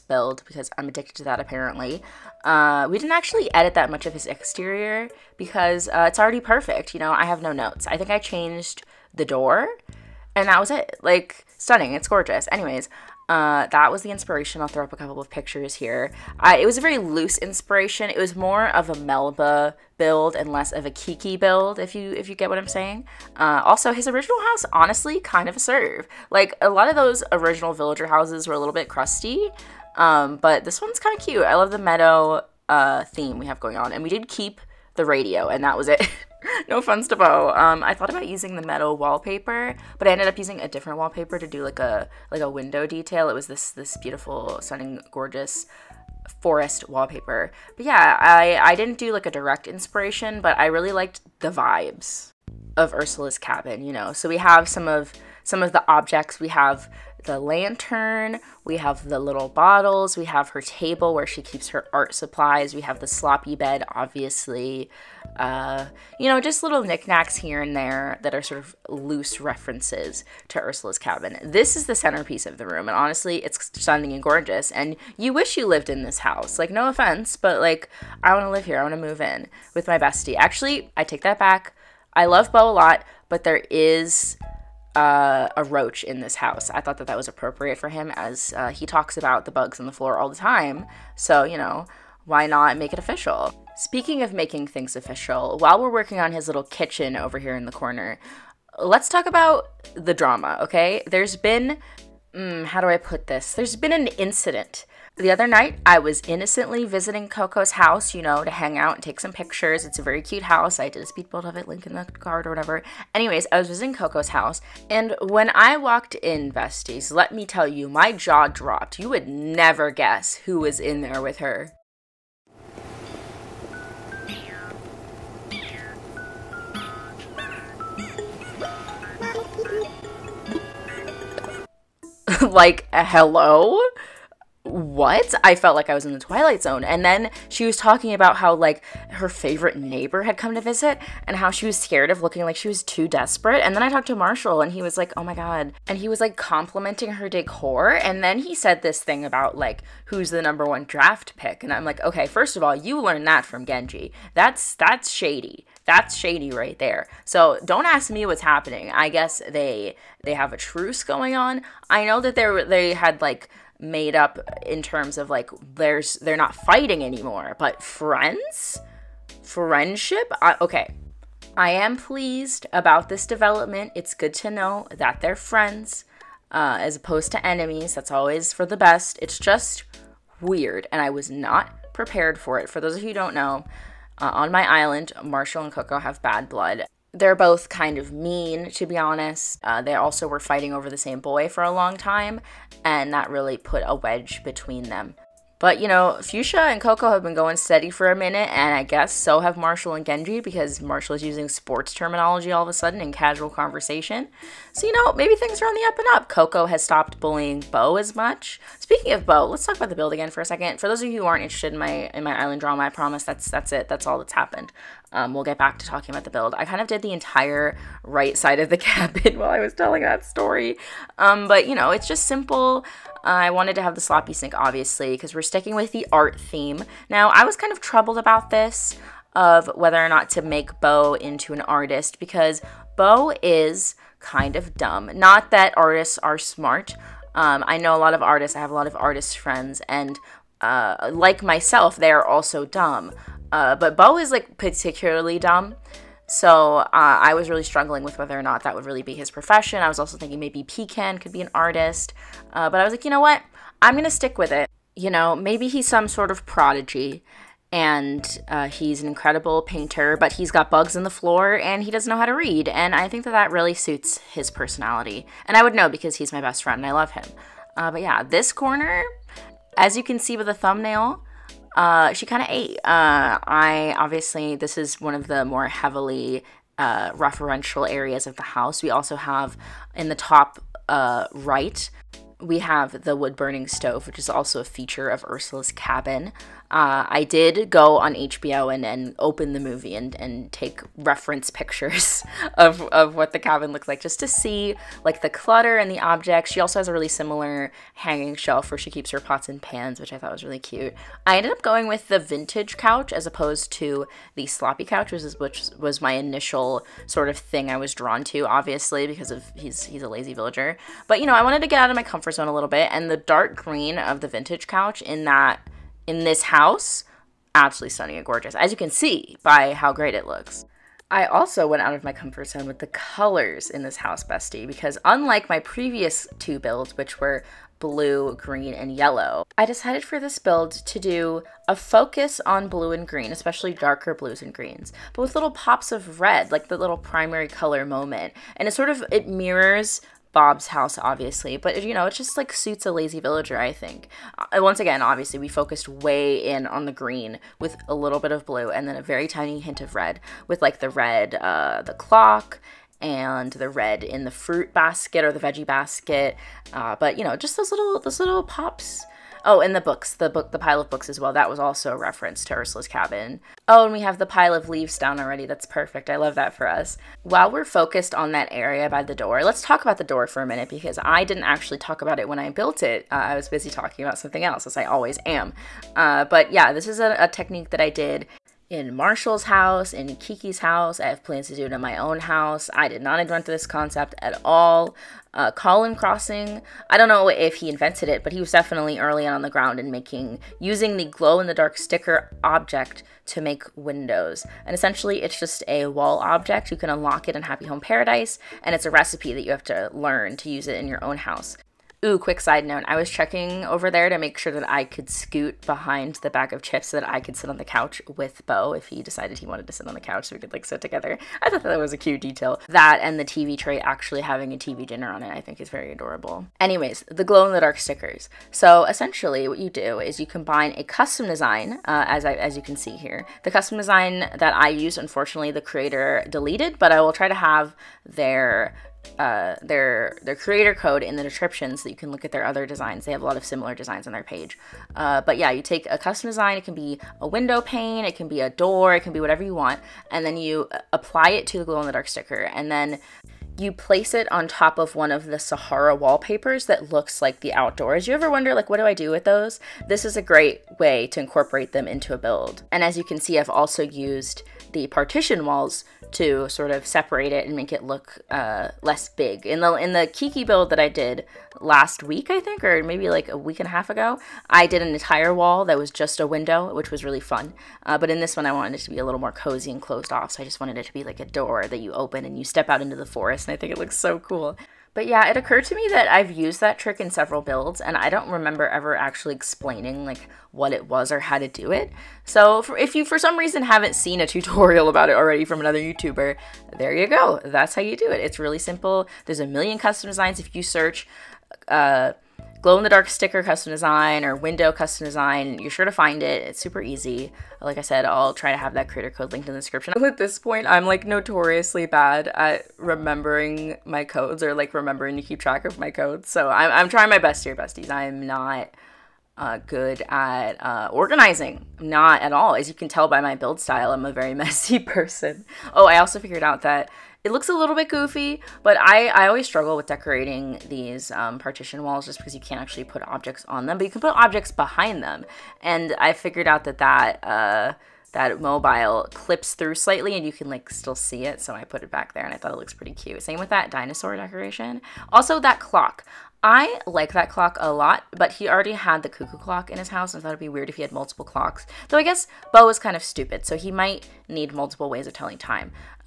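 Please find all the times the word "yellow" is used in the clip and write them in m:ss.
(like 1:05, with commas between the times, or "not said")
5:28.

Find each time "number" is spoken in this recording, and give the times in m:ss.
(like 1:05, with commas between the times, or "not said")
2:30.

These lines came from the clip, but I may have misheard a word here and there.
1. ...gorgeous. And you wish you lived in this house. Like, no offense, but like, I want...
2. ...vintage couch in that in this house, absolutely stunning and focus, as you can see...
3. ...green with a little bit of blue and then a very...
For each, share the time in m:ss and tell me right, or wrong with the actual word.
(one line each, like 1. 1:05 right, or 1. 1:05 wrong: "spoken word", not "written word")
1. 1:14 right
2. 5:14 wrong: "gorgeous", not "focus"
3. 5:46 right.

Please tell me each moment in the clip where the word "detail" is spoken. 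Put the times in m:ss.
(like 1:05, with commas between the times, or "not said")
0:42, 6:52.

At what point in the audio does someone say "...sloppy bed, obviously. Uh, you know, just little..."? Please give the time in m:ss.
1:03.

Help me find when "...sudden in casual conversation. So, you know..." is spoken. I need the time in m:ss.
3:22.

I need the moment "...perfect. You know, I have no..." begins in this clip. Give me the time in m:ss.
0:06.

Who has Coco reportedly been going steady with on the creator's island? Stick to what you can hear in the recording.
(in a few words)
Fuchsia.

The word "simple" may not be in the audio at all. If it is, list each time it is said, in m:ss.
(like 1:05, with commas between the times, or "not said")
3:42, 8:08.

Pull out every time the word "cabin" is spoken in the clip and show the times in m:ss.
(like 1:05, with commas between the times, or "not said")
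0:53, 1:10, 3:38, 4:45, 4:53, 6:02.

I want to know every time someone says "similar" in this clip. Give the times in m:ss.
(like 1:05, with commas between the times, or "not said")
4:57, 7:13.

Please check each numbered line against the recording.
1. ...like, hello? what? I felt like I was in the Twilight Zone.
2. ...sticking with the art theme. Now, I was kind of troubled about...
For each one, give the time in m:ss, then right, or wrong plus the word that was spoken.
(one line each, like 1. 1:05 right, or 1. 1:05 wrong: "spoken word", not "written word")
1. 2:12 right
2. 3:45 right.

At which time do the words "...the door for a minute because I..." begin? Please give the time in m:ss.
6:09.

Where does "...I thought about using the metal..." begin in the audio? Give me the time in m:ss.
0:37.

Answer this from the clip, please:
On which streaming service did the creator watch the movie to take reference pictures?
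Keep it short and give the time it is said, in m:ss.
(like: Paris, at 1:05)
HBO, at 4:48.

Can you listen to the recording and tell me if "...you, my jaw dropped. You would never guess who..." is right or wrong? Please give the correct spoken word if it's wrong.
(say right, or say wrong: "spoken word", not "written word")
right.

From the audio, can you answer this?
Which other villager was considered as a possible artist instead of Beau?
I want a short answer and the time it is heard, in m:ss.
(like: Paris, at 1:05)
Pecan, at 4:10.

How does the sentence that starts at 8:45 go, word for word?
And I figured out that that, uh, that mobile clips through slightly and you can like still see it.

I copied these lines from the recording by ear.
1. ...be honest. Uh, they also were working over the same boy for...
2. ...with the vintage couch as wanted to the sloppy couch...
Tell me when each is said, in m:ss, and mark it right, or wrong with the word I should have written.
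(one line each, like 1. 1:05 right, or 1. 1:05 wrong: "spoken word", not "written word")
1. 3:08 wrong: "fighting", not "working"
2. 5:01 wrong: "opposed", not "wanted".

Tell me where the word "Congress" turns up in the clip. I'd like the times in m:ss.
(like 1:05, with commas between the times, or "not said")
not said.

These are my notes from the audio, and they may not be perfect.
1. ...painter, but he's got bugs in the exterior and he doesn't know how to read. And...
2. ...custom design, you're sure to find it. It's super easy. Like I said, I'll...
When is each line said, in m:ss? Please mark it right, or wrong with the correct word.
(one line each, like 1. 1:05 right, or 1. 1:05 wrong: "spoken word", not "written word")
1. 4:19 wrong: "floor", not "exterior"
2. 8:14 right.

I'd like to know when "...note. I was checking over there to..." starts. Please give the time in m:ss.
6:42.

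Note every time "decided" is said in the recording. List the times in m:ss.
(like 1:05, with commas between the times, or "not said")
5:29, 6:49.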